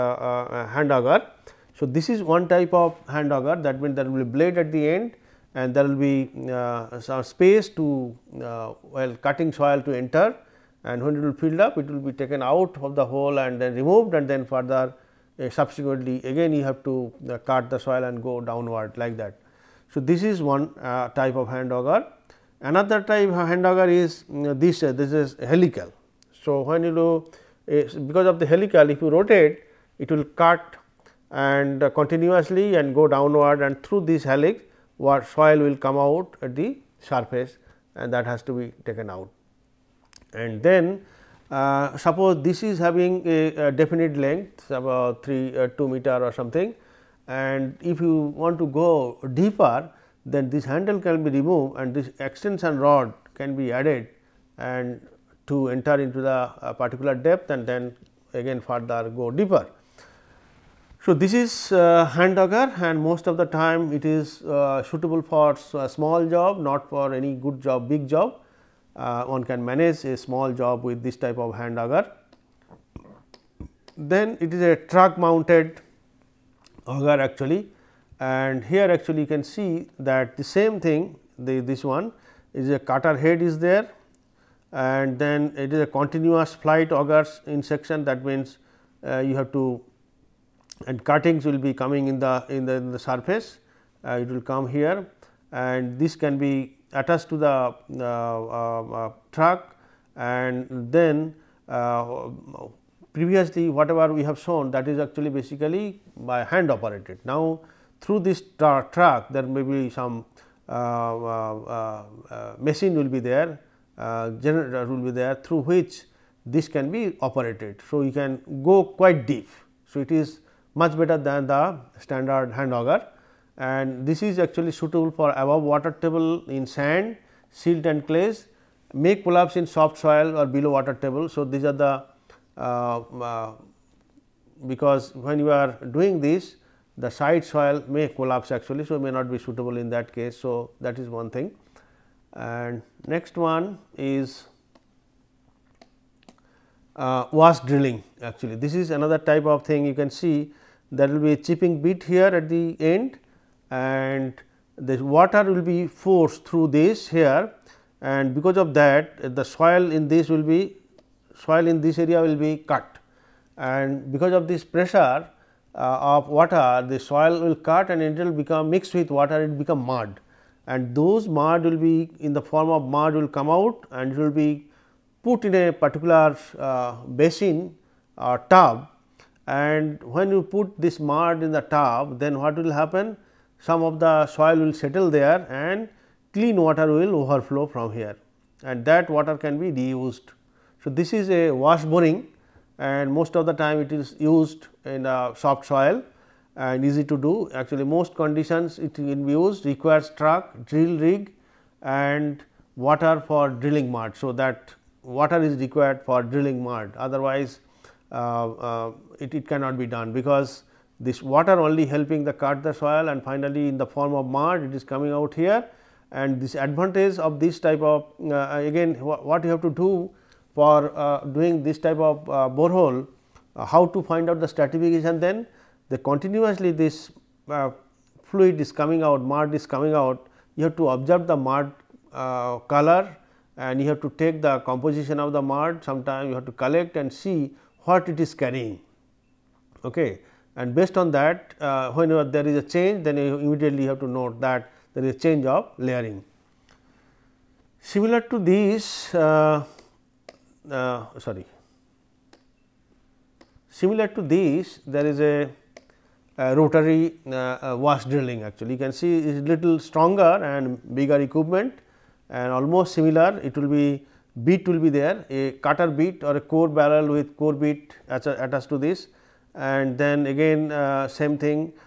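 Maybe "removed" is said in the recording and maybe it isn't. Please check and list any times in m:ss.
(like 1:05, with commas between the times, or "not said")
0:13, 0:51.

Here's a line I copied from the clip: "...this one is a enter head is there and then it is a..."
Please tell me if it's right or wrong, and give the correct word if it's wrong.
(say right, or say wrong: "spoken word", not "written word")
wrong: "cutter", not "enter".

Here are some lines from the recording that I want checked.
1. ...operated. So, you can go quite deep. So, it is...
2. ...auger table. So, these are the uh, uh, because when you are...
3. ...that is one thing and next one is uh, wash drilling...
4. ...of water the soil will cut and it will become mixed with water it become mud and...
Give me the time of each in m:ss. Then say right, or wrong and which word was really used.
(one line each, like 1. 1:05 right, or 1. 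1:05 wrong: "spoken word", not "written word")
1. 1:57 right
2. 2:10 wrong: "water", not "auger"
3. 2:20 right
4. 2:46 right.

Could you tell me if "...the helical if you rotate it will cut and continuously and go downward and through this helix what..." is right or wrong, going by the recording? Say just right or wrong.
right.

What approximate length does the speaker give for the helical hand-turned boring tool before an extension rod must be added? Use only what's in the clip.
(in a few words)
2 meters.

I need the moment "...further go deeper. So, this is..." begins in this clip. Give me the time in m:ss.
0:58.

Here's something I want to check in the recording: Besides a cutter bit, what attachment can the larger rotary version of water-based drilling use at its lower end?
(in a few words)
core barrel with core bit.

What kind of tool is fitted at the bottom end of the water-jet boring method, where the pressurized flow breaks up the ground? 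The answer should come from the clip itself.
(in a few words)
chipping bit.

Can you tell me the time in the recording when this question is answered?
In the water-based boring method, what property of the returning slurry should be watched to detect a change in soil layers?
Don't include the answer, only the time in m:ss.
3:51.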